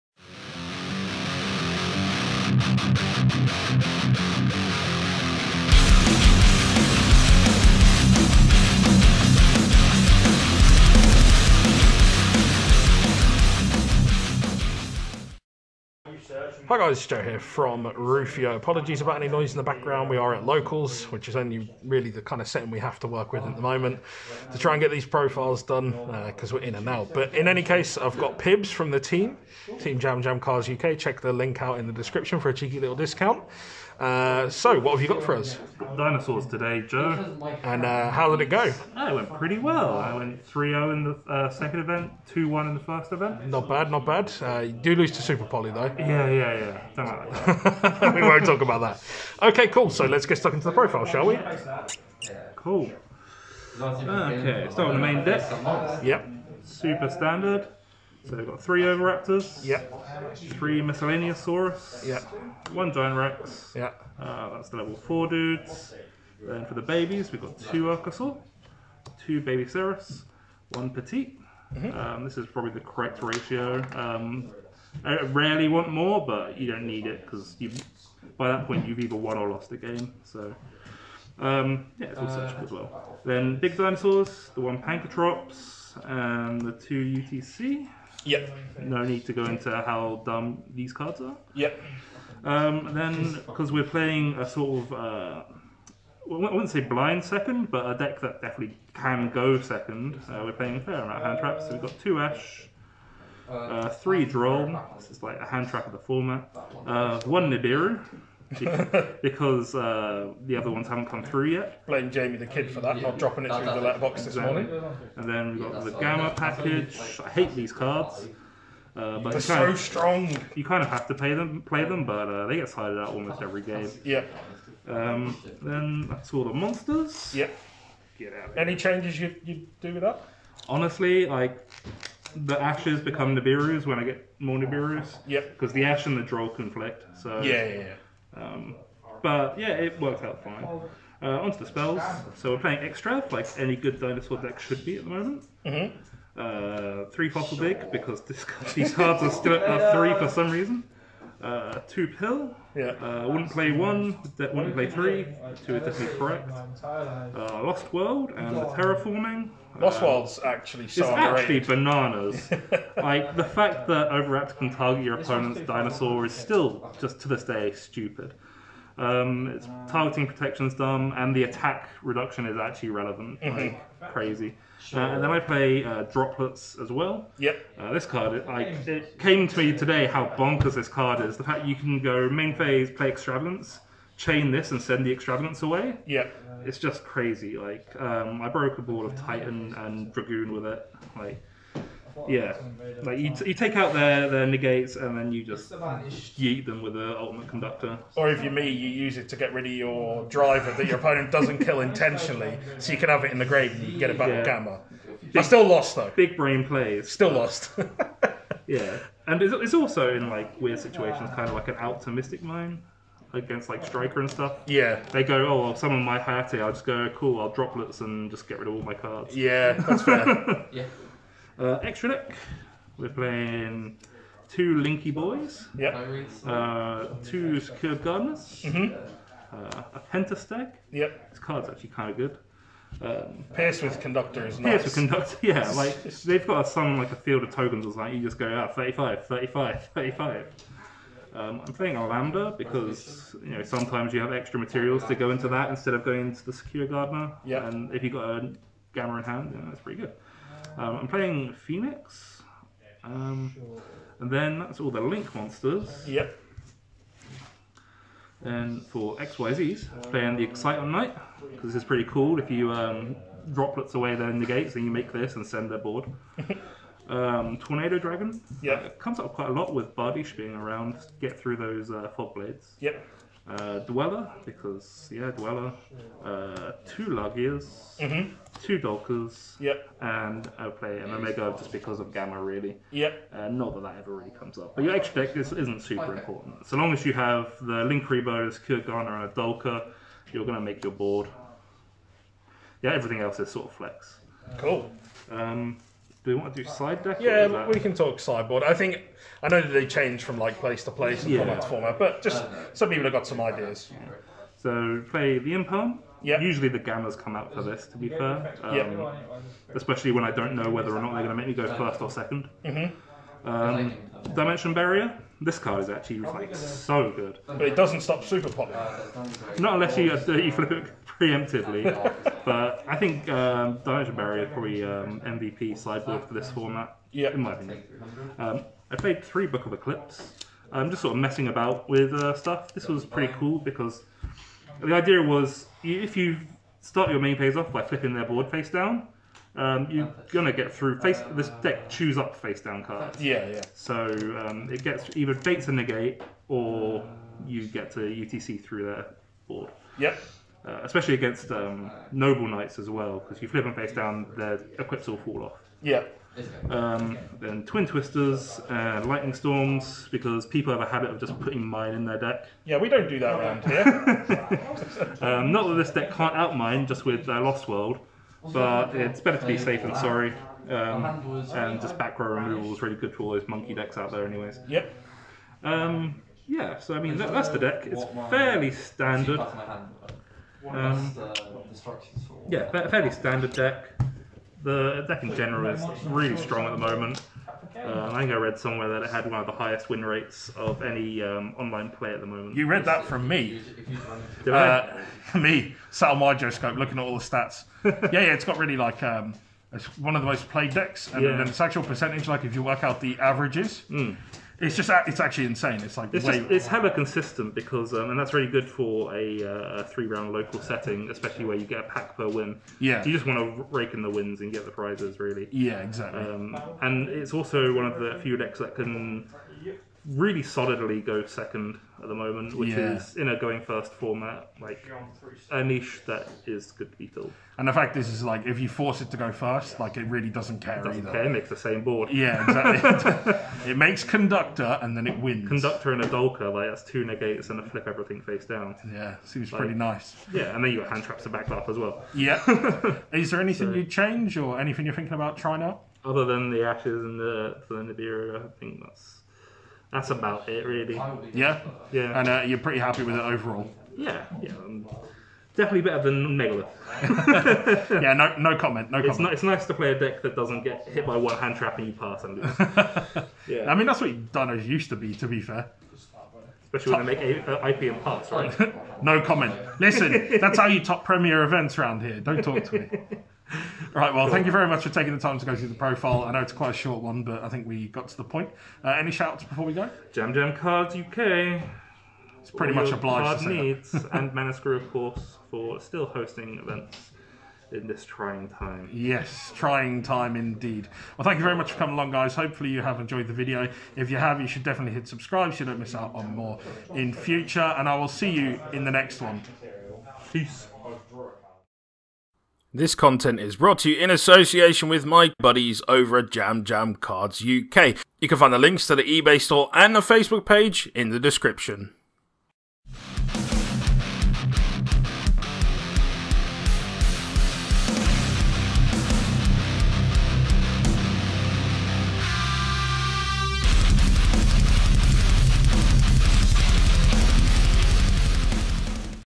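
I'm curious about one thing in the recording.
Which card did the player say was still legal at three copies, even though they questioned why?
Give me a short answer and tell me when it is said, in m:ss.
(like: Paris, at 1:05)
Fossil Dig, at 2:27.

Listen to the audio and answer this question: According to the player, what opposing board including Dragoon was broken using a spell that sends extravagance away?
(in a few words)
Titan and Dragoon.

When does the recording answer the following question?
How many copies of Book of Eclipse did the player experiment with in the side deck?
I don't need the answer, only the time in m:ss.
5:29.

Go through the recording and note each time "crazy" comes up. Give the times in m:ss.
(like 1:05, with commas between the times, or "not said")
2:54, 3:07.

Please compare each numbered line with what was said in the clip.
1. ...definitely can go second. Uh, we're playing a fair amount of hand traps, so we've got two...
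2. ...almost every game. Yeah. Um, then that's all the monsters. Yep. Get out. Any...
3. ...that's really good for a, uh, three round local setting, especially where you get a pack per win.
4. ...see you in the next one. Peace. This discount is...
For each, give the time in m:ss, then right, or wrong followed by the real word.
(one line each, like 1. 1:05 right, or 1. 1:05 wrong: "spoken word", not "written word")
1. 1:38 right
2. 2:03 right
3. 6:48 right
4. 8:18 wrong: "content", not "discount".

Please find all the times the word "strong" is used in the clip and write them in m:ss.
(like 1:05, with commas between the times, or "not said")
1:59, 6:26.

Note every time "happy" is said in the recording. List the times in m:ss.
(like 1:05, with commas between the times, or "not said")
7:32.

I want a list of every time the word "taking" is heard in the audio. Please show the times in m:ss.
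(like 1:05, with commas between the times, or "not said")
7:54.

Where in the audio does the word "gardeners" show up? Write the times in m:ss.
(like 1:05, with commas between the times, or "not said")
3:48, 4:06.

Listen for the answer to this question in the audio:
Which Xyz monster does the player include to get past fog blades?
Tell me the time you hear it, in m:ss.
4:27.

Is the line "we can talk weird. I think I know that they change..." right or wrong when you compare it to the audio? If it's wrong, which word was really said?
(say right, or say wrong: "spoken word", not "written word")
wrong: "sideboard", not "weird".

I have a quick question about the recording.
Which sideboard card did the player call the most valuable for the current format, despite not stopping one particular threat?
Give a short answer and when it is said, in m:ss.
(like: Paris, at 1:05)
Dimension Barrier, at 5:14.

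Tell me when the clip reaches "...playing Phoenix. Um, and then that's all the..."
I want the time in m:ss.
4:11.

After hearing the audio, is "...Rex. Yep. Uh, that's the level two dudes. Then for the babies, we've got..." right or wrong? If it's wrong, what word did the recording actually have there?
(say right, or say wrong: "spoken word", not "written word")
wrong: "four", not "two".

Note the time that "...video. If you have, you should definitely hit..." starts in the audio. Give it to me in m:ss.
8:13.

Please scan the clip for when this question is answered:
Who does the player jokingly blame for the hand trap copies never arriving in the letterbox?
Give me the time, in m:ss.
1:52.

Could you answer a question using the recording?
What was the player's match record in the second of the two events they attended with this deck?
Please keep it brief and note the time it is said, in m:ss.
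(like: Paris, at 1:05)
3-0, at 0:40.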